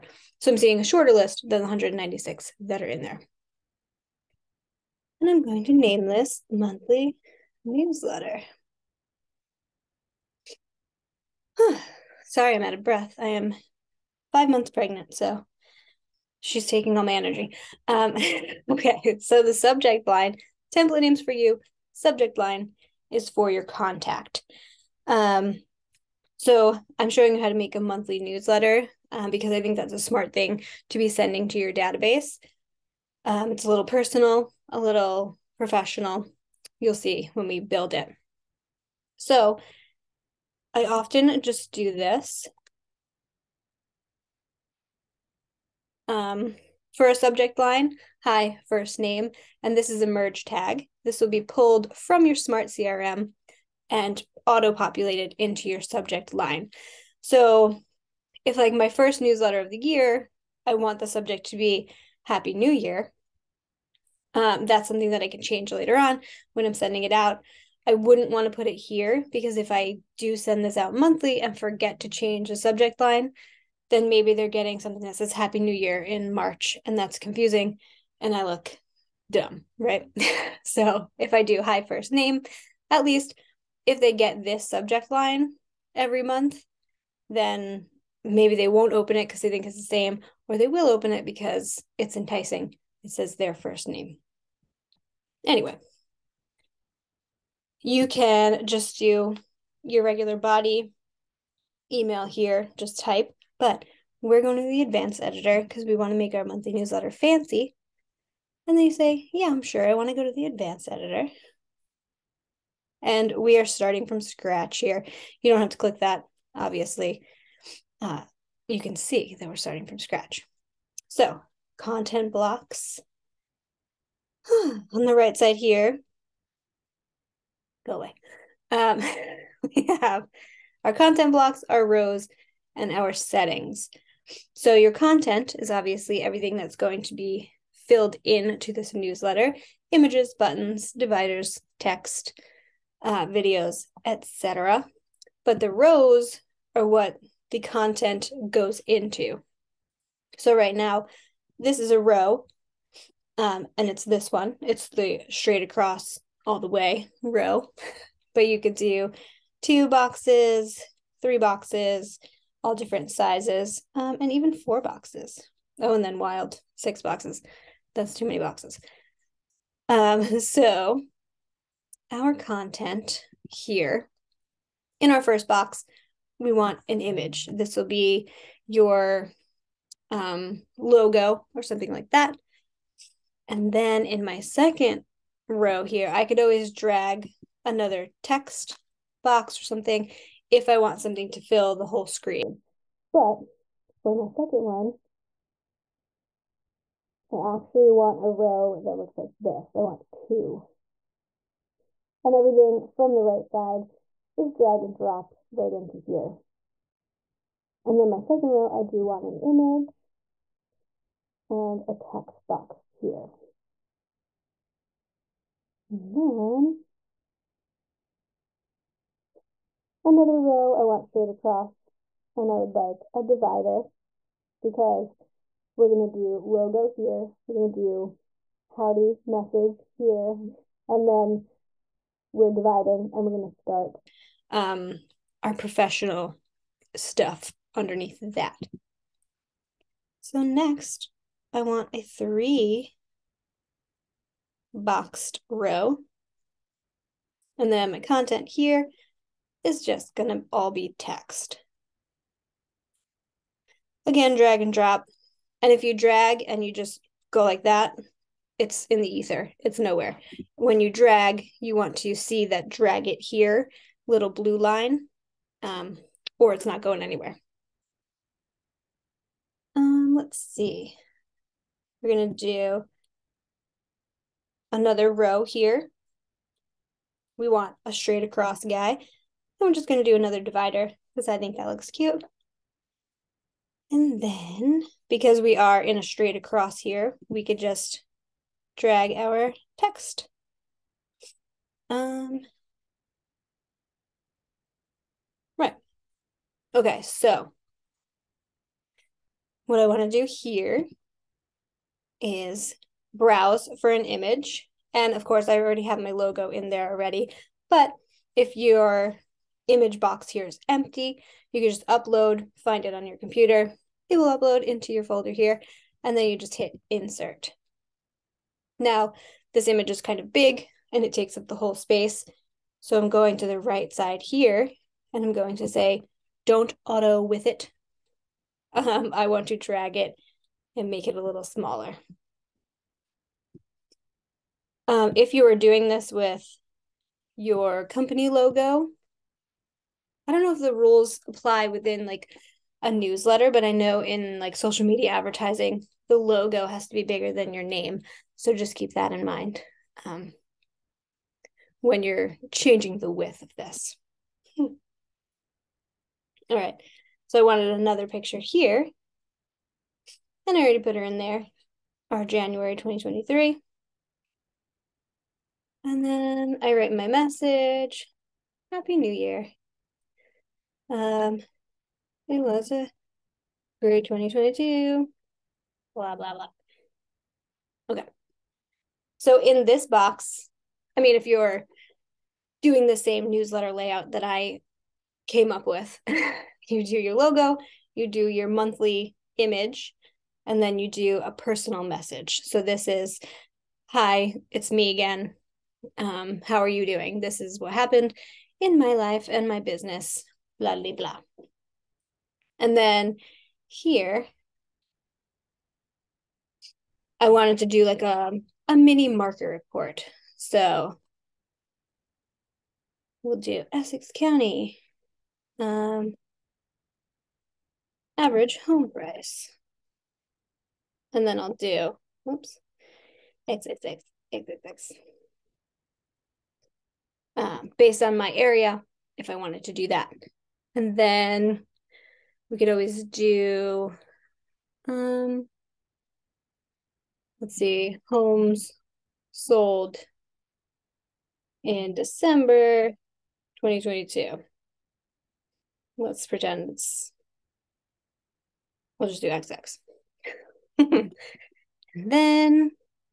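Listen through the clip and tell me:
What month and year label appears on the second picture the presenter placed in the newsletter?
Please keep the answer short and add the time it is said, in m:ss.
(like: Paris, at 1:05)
January 2023, at 6:02.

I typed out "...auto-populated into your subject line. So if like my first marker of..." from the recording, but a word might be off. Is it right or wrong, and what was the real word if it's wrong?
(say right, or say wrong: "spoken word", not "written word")
wrong: "newsletter", not "marker".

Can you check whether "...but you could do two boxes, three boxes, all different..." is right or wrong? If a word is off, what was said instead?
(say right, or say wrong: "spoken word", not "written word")
right.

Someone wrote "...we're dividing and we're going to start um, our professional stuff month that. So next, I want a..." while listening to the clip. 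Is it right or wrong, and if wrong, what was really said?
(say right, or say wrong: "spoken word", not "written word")
wrong: "underneath", not "month".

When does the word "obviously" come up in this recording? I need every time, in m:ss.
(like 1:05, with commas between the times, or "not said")
1:56, 2:15.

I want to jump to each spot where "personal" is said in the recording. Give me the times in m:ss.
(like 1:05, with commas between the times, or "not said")
0:33, 6:31.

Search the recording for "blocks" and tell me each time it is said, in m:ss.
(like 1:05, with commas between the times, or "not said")
2:02, 2:11.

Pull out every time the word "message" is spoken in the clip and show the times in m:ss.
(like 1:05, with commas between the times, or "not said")
3:49, 6:07, 6:31.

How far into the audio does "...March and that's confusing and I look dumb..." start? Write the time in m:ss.
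1:16.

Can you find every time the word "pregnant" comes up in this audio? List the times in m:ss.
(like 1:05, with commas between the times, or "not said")
0:14.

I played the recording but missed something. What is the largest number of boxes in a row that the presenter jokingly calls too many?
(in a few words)
6.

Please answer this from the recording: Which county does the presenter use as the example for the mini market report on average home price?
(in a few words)
Essex County.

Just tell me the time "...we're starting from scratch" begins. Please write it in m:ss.
1:59.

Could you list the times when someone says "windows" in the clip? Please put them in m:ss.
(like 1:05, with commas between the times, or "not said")
not said.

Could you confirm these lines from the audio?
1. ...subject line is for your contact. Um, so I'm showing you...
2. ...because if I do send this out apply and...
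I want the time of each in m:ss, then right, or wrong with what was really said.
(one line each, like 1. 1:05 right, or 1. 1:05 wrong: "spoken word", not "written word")
1. 0:21 right
2. 1:09 wrong: "monthly", not "apply".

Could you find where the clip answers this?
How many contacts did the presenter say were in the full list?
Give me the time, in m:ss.
0:01.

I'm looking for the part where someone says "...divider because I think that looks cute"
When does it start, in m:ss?
4:40.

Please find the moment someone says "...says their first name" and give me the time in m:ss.
1:33.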